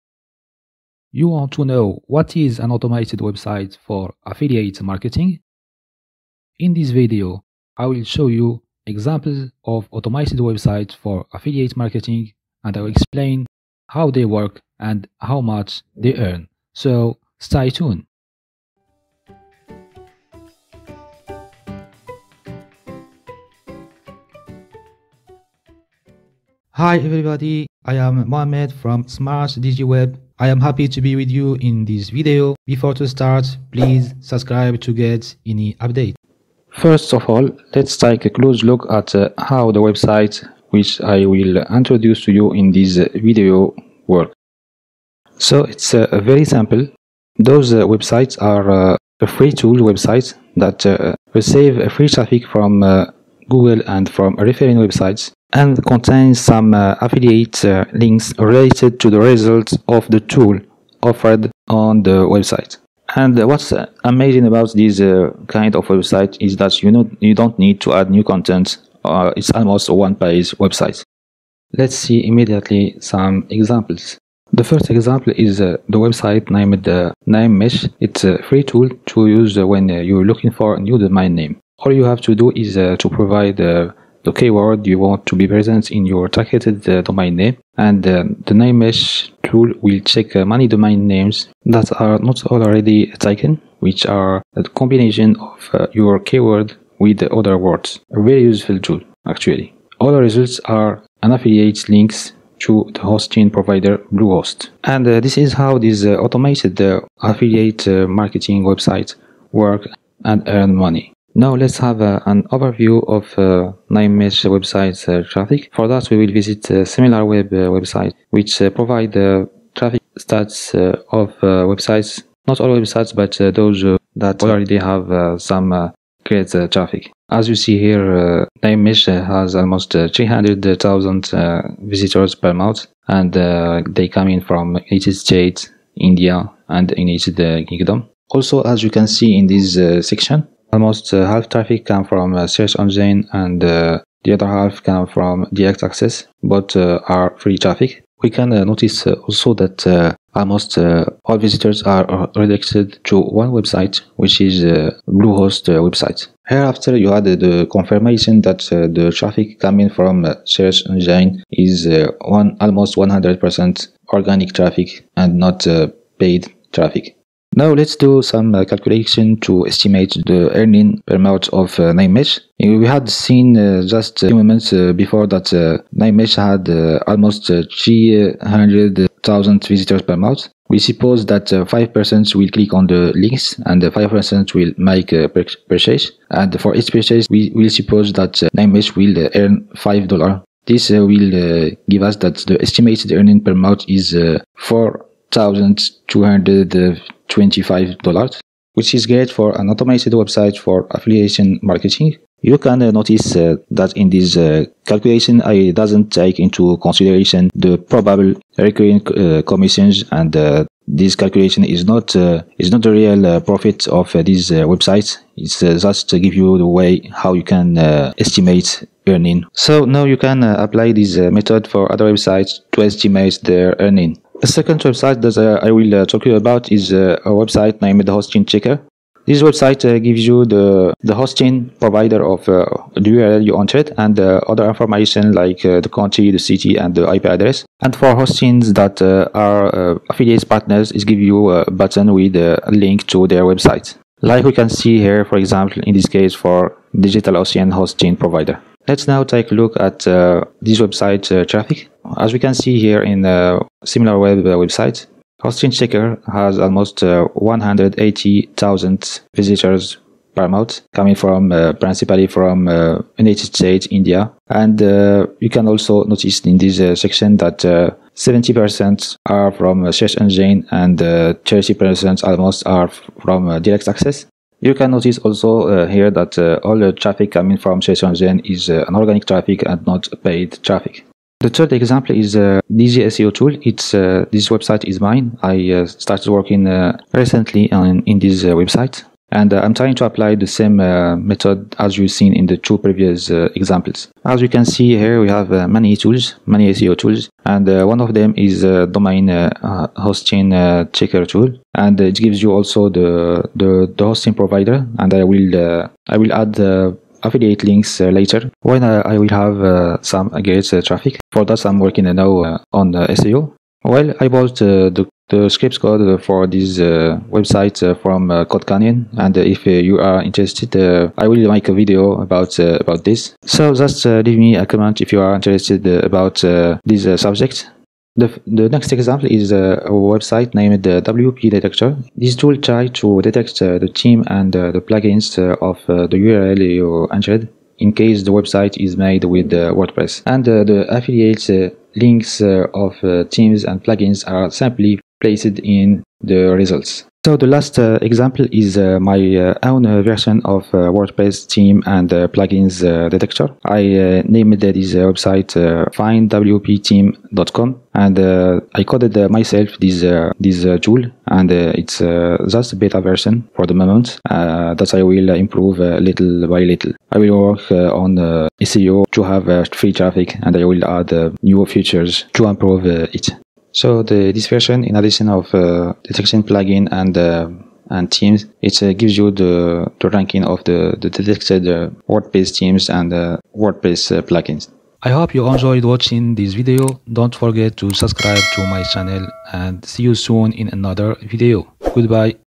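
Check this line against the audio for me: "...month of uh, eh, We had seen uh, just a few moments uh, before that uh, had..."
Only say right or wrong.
right.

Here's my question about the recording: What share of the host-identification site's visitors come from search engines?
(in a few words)
70%.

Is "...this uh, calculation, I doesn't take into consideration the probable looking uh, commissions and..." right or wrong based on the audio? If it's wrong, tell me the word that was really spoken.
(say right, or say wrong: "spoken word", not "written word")
wrong: "recurring", not "looking".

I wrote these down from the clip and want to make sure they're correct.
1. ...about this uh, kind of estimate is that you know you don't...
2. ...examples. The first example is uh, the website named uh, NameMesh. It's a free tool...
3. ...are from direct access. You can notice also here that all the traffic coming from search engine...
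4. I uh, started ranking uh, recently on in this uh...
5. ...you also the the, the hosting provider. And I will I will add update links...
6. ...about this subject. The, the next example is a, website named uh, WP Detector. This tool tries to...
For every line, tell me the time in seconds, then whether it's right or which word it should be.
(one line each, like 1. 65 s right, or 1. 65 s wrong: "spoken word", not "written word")
1. 64 s wrong: "website", not "estimate"
2. 73 s right
3. 272 s right
4. 285 s wrong: "working", not "ranking"
5. 302 s wrong: "affiliate", not "update"
6. 325 s right.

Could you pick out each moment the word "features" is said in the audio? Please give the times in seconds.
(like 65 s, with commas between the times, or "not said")
371 s.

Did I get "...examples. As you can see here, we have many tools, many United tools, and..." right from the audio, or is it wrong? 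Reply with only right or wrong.
wrong.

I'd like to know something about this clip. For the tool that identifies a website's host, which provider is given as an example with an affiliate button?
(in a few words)
DigitalOcean.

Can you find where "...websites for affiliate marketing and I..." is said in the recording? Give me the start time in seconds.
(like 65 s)
10 s.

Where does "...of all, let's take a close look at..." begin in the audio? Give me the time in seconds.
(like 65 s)
37 s.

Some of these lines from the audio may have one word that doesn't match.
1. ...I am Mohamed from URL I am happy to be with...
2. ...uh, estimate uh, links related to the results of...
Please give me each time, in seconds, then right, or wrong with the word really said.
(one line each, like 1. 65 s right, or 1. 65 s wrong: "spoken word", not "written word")
1. 27 s wrong: "SmartDigiWeb", not "URL"
2. 56 s wrong: "affiliate", not "estimate".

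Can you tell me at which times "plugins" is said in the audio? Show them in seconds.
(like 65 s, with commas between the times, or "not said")
334 s, 343 s, 352 s, 376 s, 384 s.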